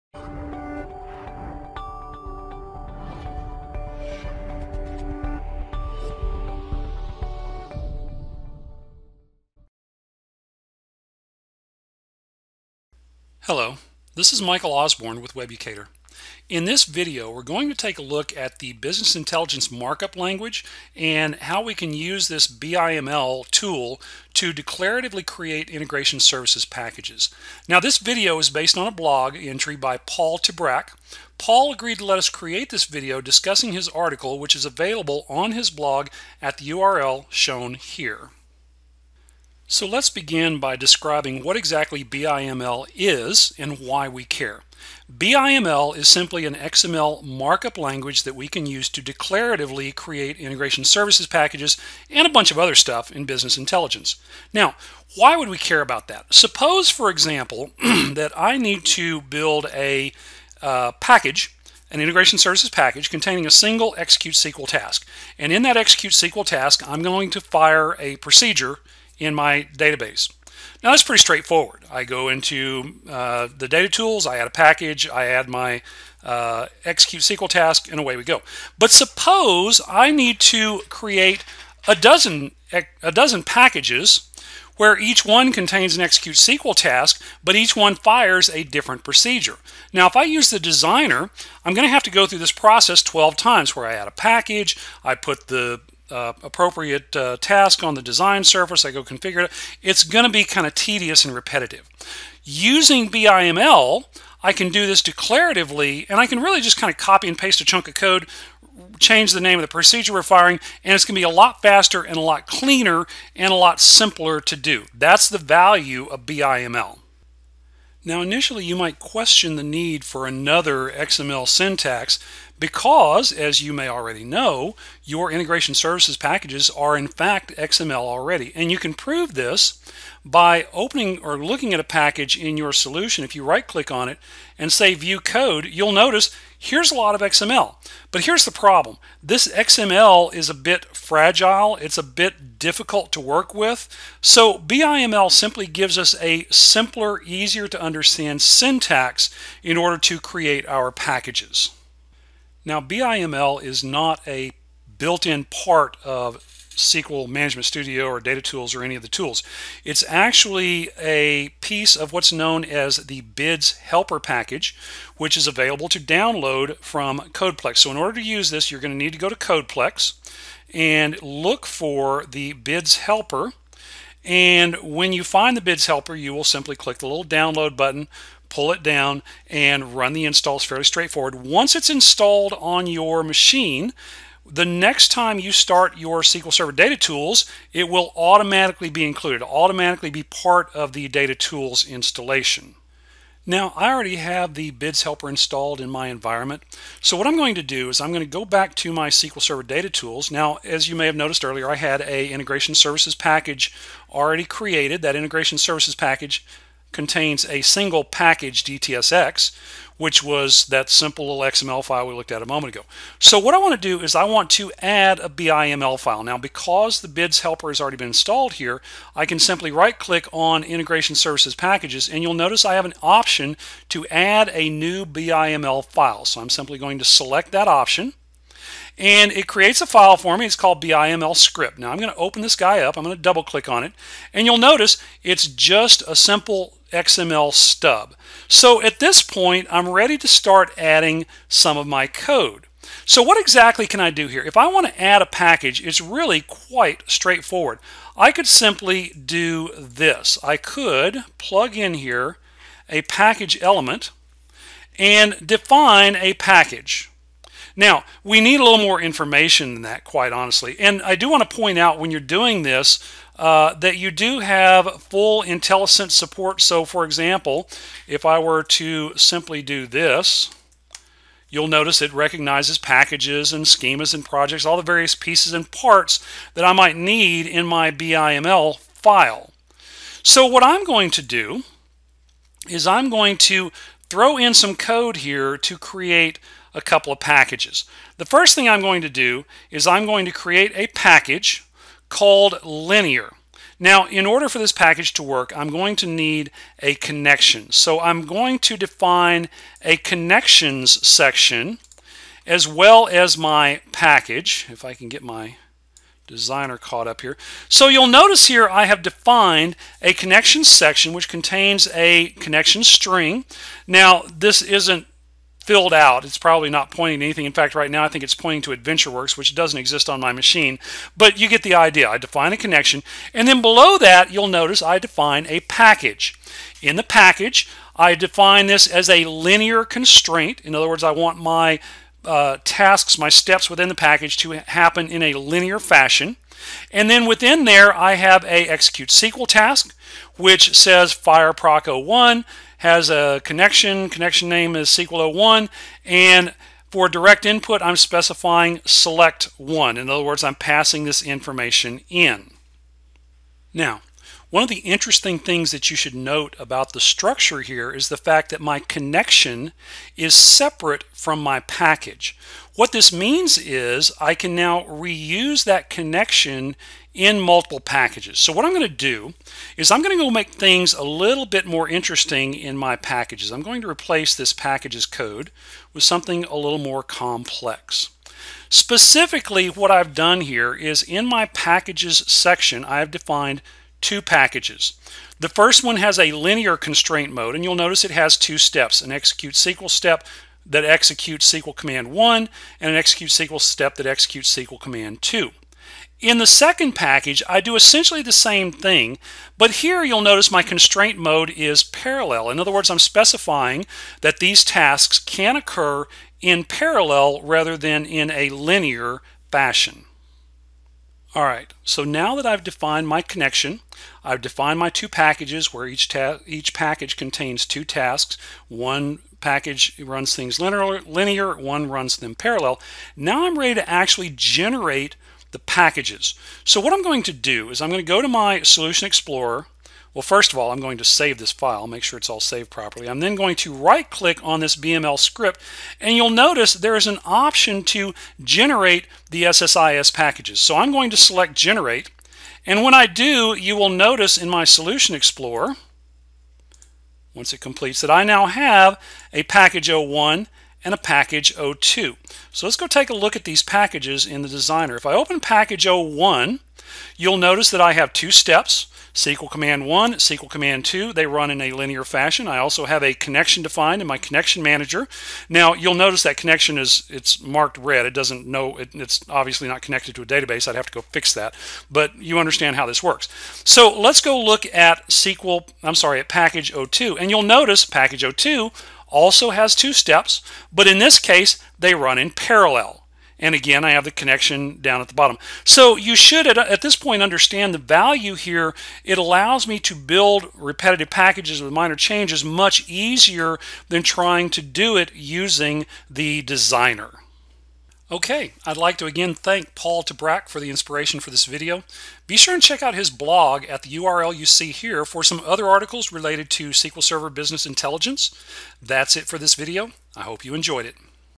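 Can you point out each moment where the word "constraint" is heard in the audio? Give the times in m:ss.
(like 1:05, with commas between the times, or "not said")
5:29, 6:26, 6:40.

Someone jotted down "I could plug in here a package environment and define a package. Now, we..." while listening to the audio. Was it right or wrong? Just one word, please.
wrong.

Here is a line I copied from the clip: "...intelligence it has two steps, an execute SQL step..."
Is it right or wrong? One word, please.
wrong.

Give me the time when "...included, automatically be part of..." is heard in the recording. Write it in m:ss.
3:09.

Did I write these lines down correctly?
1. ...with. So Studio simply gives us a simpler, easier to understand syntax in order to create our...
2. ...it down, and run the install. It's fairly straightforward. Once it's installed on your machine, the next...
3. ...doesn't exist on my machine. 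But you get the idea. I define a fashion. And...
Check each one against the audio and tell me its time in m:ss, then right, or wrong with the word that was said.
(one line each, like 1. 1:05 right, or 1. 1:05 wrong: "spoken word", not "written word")
1. 2:23 wrong: "BIML", not "Studio"
2. 2:58 right
3. 5:19 wrong: "connection", not "fashion".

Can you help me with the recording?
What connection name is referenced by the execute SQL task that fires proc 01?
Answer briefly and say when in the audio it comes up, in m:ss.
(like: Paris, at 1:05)
SQL01, at 5:44.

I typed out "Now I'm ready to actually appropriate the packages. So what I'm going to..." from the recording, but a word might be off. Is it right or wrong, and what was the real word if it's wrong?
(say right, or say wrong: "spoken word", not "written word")
wrong: "generate", not "appropriate".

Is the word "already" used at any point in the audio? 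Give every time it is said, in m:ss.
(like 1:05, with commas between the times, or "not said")
2:03, 2:08, 3:13, 3:24, 3:37.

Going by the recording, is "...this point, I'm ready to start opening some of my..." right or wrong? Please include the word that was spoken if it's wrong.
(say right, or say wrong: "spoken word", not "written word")
wrong: "adding", not "opening".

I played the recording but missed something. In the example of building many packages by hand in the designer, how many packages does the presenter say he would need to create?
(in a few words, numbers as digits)
12.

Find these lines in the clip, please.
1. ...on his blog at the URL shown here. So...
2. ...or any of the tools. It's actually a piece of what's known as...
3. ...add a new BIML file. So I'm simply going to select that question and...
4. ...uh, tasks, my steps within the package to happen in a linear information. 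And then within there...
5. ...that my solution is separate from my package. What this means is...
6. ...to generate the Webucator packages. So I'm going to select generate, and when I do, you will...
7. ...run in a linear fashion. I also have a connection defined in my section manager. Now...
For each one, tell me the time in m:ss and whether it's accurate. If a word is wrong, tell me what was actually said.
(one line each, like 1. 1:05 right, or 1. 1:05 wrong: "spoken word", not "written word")
1. 0:35 right
2. 2:38 right
3. 3:44 wrong: "option", not "question"
4. 5:32 wrong: "fashion", not "information"
5. 5:58 wrong: "connection", not "solution"
6. 7:17 wrong: "SSIS", not "Webucator"
7. 7:41 wrong: "connection", not "section".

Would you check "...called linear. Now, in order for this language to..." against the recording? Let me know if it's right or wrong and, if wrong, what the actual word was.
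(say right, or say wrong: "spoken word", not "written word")
wrong: "package", not "language".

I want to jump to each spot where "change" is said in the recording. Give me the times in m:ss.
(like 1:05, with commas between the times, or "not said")
1:48, 8:11.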